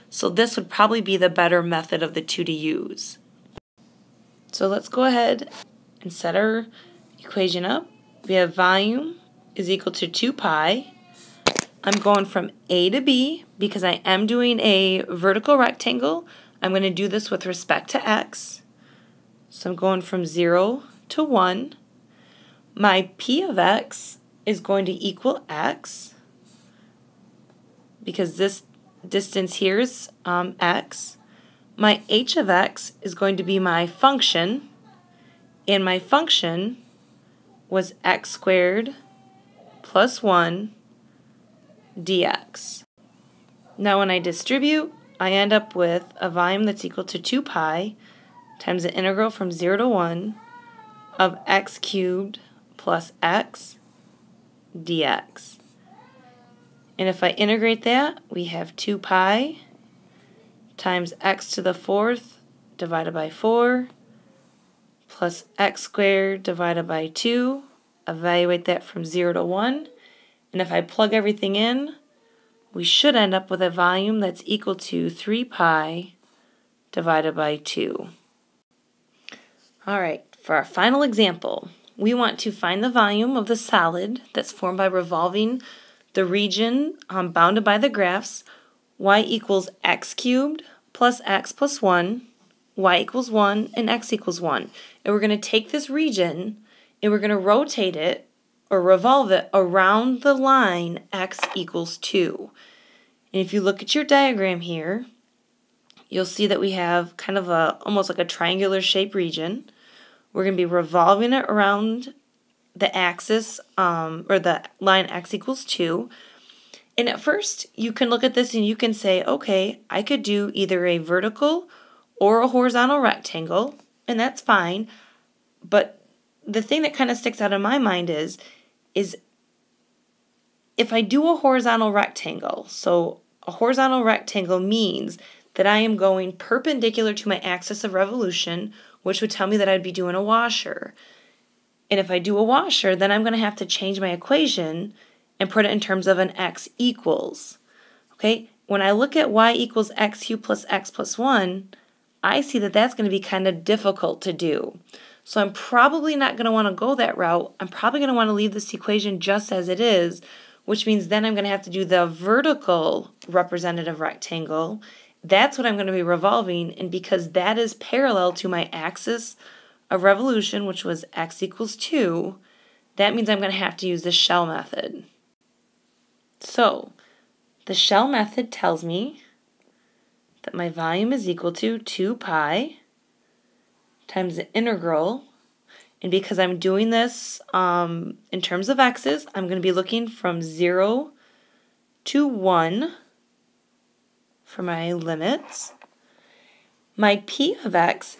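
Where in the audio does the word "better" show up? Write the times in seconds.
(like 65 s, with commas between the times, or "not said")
1 s.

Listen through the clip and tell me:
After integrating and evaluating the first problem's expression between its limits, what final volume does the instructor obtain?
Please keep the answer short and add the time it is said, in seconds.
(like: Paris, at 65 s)
3 pi/2, at 75 s.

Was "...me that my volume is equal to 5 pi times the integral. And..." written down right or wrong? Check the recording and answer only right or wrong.
wrong.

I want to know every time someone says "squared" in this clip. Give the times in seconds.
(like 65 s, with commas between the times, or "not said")
38 s, 65 s.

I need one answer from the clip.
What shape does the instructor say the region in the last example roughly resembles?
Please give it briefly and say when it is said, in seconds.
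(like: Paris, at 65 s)
triangular, at 108 s.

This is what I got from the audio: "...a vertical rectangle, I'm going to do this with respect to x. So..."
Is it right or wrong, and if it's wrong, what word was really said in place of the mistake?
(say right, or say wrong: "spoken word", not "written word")
right.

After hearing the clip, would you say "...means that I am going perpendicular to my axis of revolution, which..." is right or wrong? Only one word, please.
right.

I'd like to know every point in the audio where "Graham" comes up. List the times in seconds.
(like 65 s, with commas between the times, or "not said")
not said.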